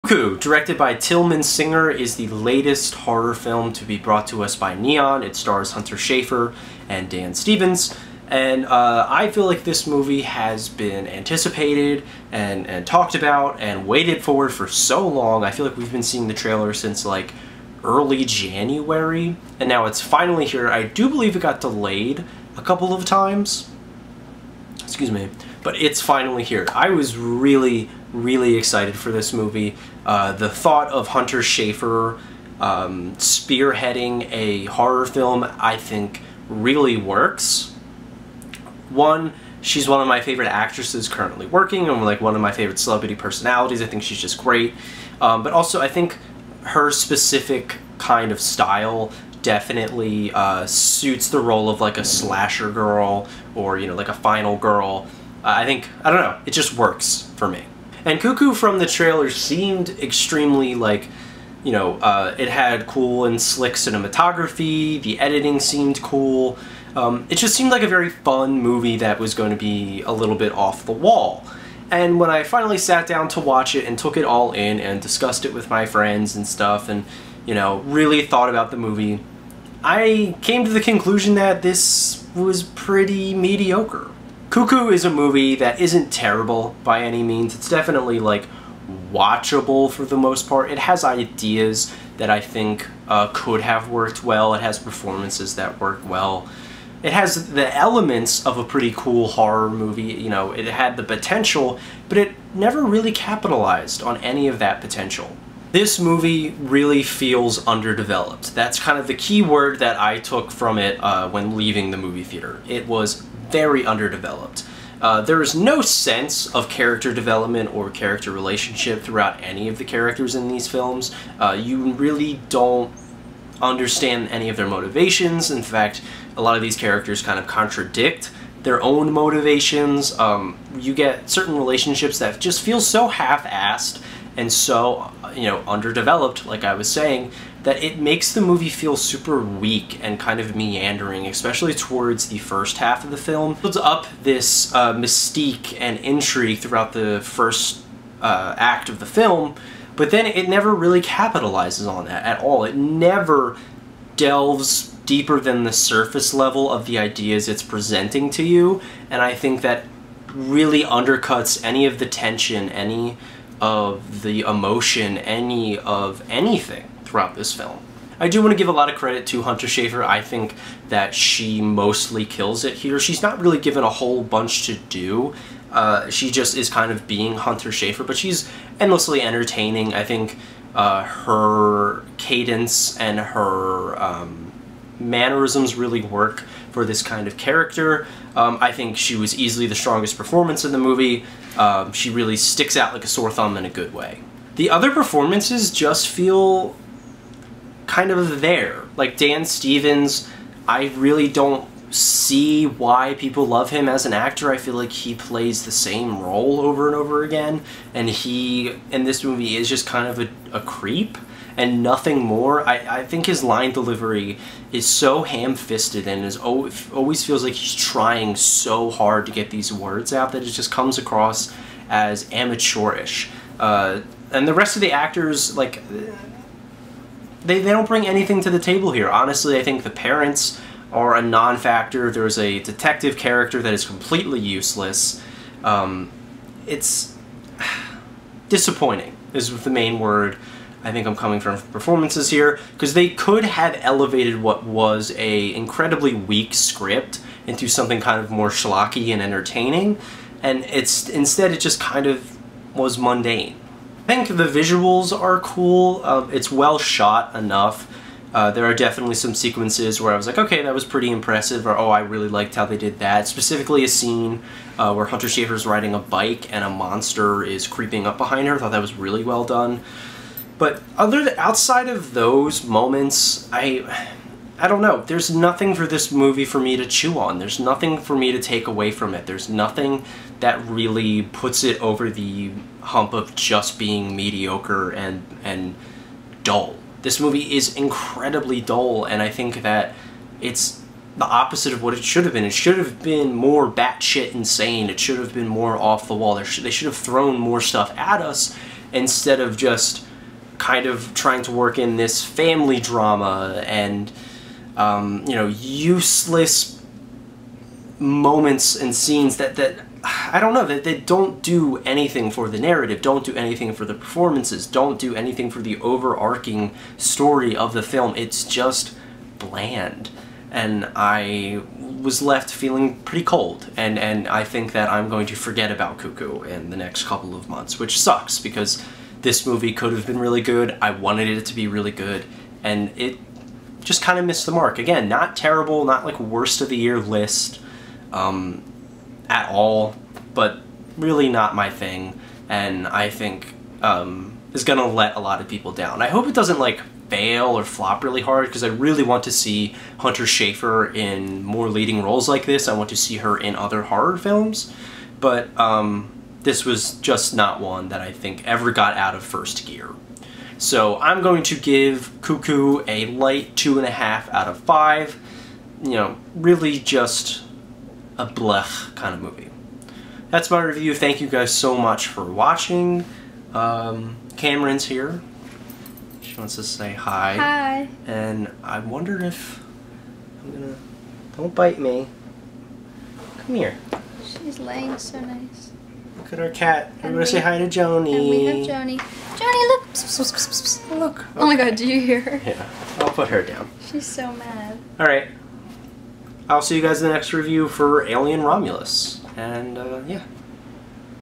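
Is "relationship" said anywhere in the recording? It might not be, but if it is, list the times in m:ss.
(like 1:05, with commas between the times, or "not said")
1:58, 2:11.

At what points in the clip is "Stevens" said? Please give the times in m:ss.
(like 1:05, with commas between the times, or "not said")
0:07, 3:19.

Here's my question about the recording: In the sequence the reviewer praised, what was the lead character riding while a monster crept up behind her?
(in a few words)
a bike.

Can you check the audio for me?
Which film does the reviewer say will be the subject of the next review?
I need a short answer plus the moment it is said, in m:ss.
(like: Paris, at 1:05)
Alien Romulus, at 6:38.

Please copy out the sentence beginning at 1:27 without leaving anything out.
It's definitely like watchable for the most part.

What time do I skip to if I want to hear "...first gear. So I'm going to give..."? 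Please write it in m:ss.
5:59.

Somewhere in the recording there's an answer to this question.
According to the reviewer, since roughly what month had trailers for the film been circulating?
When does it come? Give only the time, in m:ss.
0:17.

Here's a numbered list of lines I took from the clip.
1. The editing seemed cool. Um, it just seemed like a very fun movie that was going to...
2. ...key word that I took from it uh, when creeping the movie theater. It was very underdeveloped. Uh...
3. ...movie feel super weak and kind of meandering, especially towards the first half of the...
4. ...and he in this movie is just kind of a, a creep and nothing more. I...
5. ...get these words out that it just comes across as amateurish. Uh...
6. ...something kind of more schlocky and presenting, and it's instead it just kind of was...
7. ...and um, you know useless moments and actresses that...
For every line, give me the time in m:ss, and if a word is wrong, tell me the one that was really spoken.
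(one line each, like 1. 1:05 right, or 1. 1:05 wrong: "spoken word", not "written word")
1. 1:05 right
2. 1:49 wrong: "leaving", not "creeping"
3. 2:18 right
4. 3:27 right
5. 3:39 right
6. 4:07 wrong: "entertaining", not "presenting"
7. 5:03 wrong: "scenes", not "actresses".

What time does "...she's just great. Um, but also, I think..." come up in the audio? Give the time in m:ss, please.
0:44.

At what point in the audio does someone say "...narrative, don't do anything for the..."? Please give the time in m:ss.
5:12.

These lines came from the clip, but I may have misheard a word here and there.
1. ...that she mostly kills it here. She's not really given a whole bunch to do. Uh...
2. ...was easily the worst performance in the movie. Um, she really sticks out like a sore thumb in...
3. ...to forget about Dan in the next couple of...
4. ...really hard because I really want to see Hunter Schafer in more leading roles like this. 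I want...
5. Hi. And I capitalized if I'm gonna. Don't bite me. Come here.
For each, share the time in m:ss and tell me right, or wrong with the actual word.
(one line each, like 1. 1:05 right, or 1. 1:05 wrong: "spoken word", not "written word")
1. 2:50 right
2. 3:09 wrong: "strongest", not "worst"
3. 5:25 wrong: "Cuckoo", not "Dan"
4. 5:48 right
5. 6:17 wrong: "wondered", not "capitalized".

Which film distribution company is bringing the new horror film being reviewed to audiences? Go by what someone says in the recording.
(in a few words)
Neon.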